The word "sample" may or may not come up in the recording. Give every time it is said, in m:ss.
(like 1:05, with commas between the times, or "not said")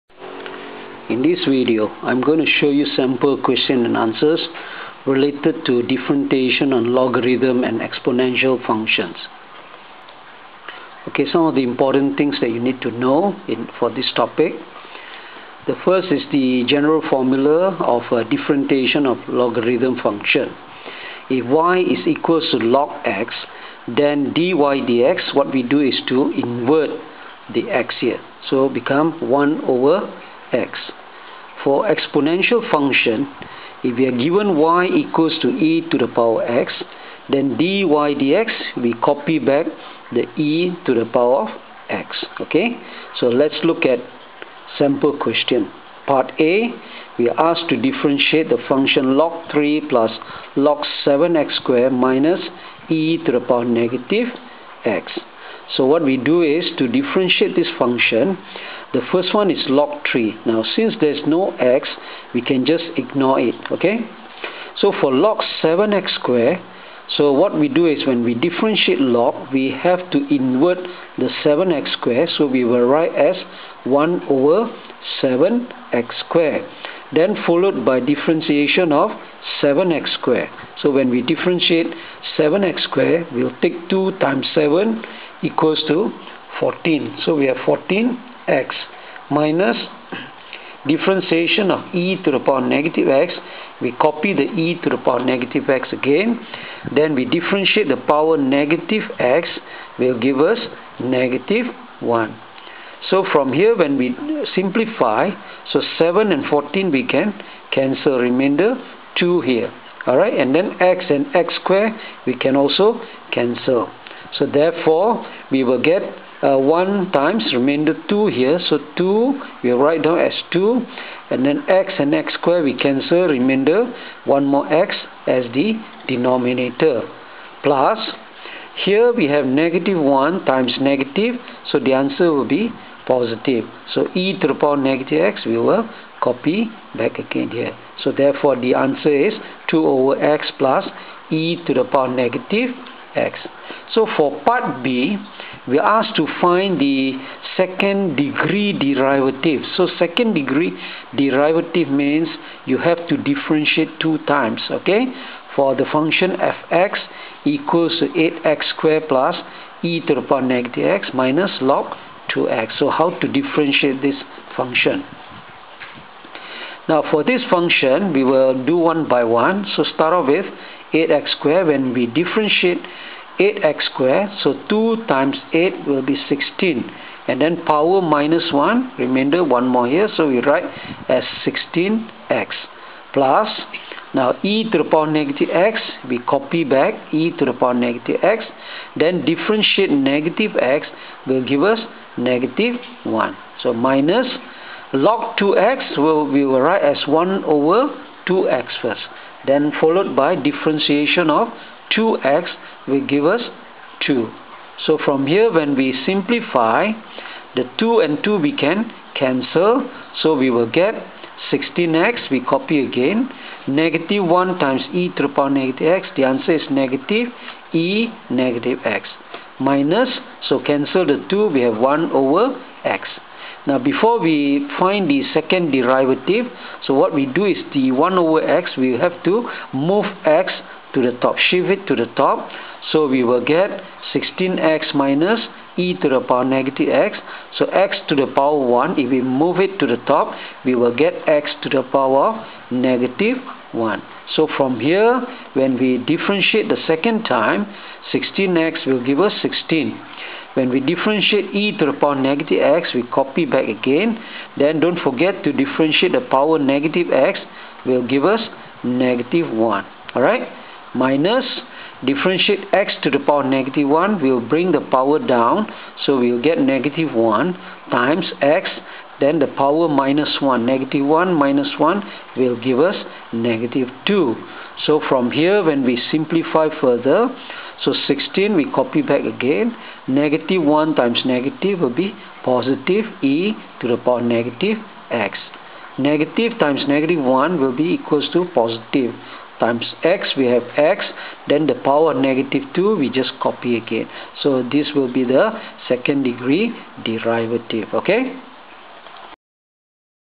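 0:02, 0:44.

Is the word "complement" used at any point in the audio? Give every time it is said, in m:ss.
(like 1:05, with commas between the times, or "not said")
not said.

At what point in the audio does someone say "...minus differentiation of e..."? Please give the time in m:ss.
1:29.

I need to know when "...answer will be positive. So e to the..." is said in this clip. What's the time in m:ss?
2:11.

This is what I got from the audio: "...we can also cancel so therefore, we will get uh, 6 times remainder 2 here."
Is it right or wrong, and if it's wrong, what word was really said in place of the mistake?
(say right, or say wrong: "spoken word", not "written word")
wrong: "1", not "6".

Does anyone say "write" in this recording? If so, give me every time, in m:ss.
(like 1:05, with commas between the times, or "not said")
1:12, 1:59, 3:00, 3:16.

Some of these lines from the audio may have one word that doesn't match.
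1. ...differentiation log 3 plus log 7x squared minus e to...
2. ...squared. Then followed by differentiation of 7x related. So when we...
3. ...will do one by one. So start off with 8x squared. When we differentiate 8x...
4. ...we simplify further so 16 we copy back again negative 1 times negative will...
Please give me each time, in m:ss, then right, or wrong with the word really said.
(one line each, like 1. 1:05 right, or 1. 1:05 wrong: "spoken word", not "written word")
1. 0:48 wrong: "function", not "differentiation"
2. 1:16 wrong: "squared", not "related"
3. 2:48 right
4. 4:35 right.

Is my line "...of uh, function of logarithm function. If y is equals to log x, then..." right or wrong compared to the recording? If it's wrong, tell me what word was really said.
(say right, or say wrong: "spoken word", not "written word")
wrong: "differentiation", not "function".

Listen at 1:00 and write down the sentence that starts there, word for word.
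Now since there's no x, we can just ignore it, okay?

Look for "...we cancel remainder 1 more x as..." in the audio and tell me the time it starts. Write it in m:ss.
2:02.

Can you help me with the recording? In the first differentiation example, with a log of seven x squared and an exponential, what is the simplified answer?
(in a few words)
2 over x plus e^-x.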